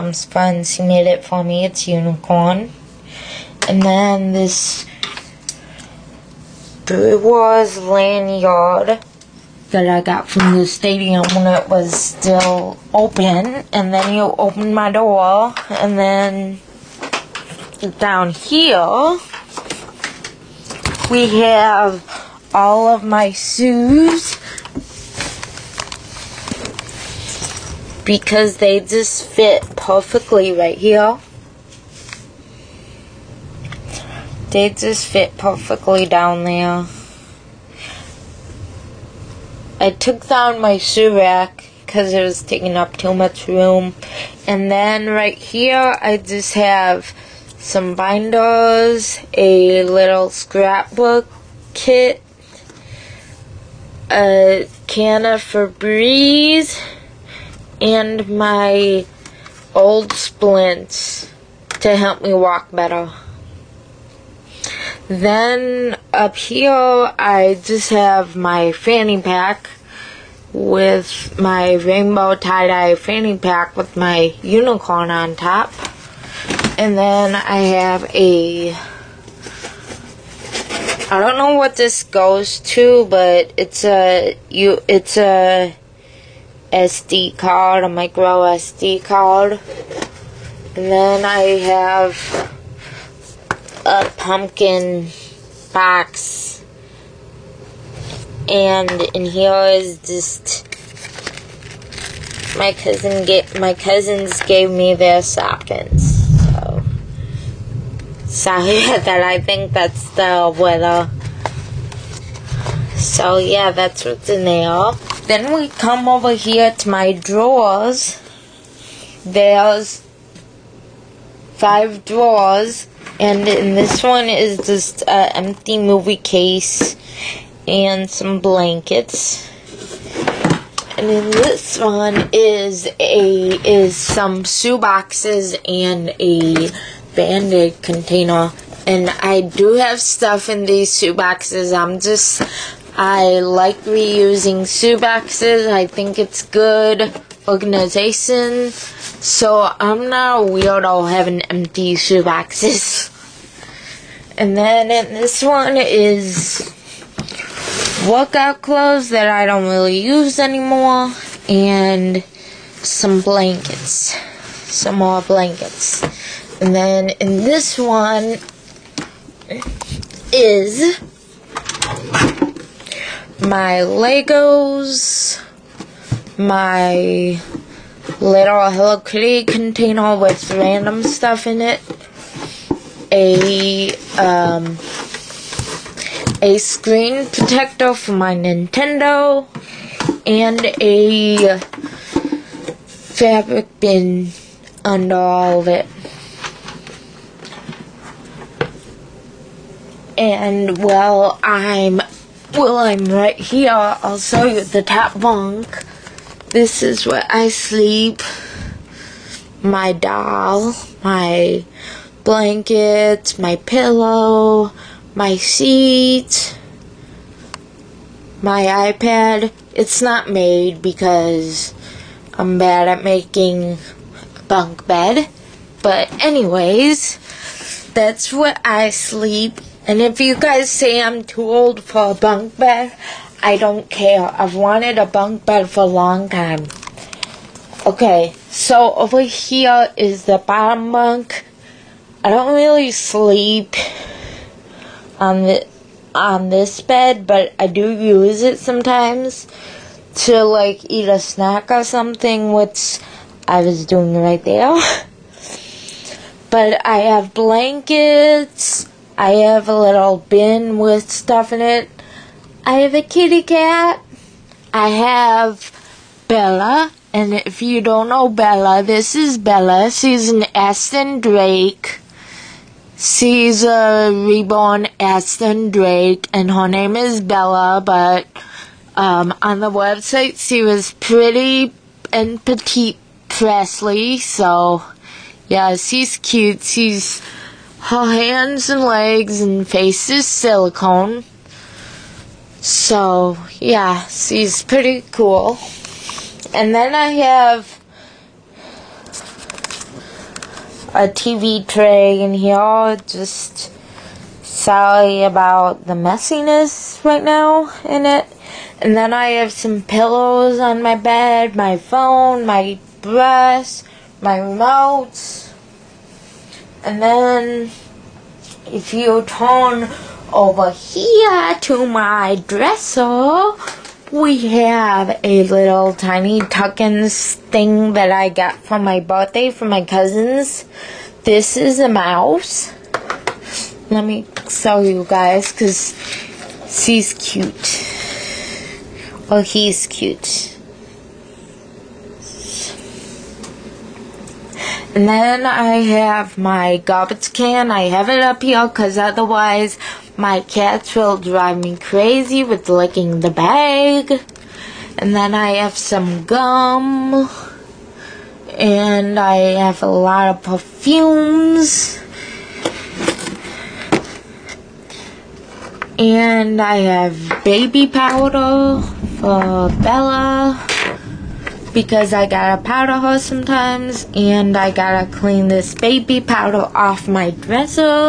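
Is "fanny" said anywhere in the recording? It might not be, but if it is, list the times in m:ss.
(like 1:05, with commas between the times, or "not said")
1:08, 1:12.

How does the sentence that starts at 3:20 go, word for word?
and well, I'm well, I'm right here.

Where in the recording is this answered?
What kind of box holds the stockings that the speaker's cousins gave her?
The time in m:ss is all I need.
1:34.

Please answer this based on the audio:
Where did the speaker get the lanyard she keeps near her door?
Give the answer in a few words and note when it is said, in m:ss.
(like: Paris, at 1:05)
The stadium, at 0:10.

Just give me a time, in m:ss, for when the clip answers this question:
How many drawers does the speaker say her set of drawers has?
2:01.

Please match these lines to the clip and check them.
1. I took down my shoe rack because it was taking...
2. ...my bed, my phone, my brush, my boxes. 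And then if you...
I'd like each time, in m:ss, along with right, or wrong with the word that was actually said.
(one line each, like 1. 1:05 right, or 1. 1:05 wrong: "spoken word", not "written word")
1. 0:39 right
2. 5:10 wrong: "remotes", not "boxes".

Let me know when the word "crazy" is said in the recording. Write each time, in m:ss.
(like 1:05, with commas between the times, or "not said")
5:51.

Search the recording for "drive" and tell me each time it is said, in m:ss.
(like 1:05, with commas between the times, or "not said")
5:51.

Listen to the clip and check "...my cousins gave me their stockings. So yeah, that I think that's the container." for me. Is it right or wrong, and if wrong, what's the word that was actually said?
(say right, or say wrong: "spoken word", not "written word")
wrong: "weather", not "container".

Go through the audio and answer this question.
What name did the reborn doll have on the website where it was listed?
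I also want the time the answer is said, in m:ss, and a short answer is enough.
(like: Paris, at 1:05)
Pretty and Petite Presley, at 4:40.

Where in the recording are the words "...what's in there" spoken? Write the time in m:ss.
1:54.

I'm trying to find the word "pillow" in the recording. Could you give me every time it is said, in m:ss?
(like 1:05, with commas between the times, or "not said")
3:33, 5:09.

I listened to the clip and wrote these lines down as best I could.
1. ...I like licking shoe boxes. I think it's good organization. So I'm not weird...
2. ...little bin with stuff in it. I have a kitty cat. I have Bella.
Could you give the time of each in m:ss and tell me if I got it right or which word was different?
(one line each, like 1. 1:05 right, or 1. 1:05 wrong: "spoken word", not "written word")
1. 2:22 wrong: "reusing", not "licking"
2. 4:19 right.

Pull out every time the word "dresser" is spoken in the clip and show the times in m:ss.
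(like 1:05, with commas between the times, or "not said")
5:22, 6:17.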